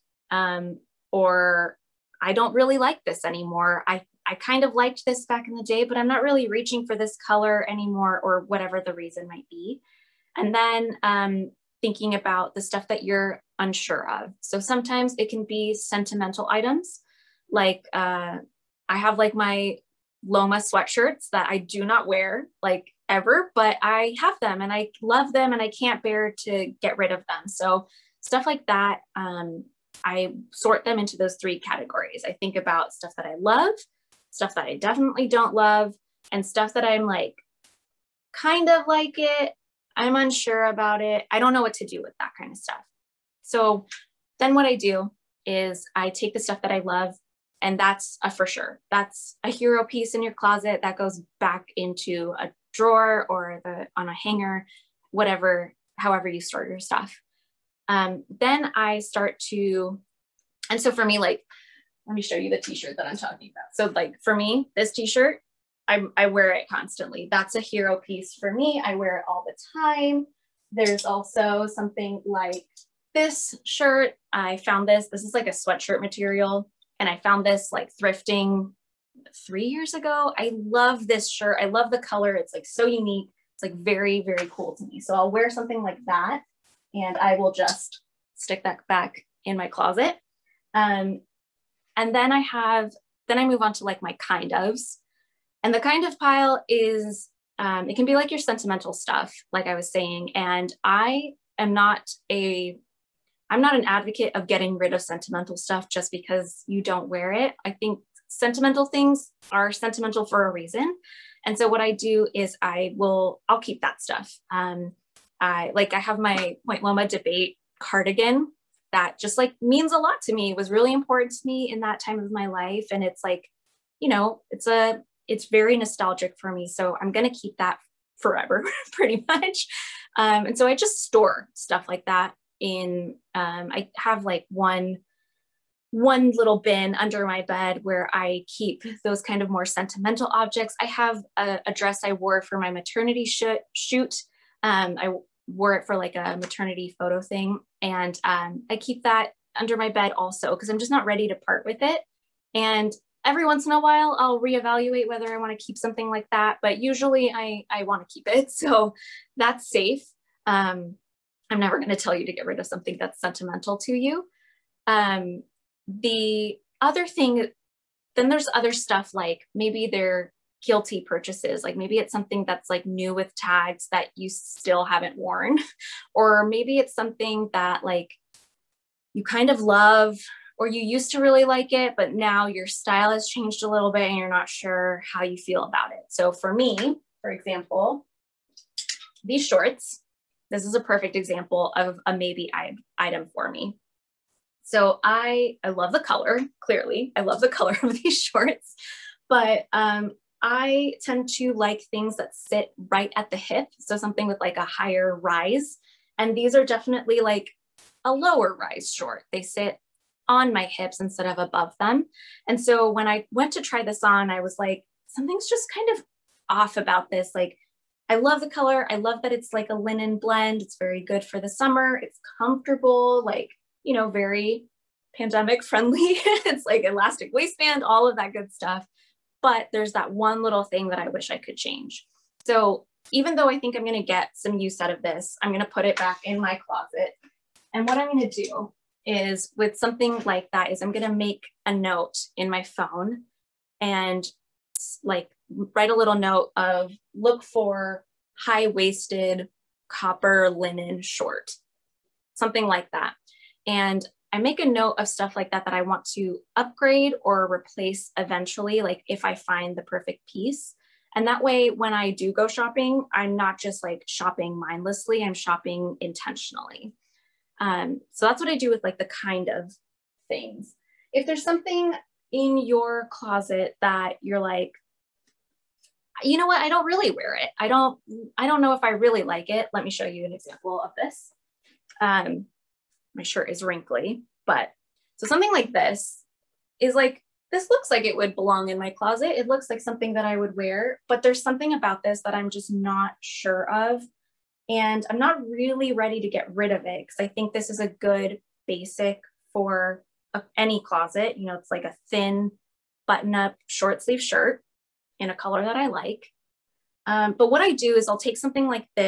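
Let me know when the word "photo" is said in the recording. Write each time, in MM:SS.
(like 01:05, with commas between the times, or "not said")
02:26.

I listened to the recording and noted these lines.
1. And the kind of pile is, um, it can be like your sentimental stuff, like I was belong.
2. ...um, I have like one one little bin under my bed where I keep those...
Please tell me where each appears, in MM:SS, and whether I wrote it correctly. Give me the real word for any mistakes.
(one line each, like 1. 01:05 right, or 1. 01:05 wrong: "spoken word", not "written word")
1. 01:35 wrong: "saying", not "belong"
2. 02:13 right.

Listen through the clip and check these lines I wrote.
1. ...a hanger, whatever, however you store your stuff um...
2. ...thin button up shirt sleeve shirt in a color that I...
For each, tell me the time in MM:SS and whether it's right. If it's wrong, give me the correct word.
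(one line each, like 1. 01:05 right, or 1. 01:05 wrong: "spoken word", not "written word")
1. 00:54 right
2. 05:02 wrong: "short", not "shirt".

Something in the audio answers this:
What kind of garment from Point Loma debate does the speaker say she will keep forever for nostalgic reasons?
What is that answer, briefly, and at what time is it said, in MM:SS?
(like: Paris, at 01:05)
cardigan, at 01:57.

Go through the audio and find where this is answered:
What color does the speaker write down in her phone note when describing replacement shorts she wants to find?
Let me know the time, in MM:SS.
04:09.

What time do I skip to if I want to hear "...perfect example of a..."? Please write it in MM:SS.
03:10.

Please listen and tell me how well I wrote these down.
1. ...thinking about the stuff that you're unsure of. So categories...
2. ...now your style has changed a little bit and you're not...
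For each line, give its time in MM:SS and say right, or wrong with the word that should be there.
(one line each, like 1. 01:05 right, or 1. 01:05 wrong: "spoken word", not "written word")
1. 00:11 wrong: "sometimes", not "categories"
2. 03:02 right.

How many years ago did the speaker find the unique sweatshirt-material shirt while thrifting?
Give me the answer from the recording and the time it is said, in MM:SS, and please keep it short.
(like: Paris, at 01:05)
3, at 01:19.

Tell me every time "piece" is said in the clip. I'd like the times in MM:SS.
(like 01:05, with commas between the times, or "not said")
00:49, 01:07, 04:20.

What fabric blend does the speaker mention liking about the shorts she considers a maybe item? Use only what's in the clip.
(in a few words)
linen blend.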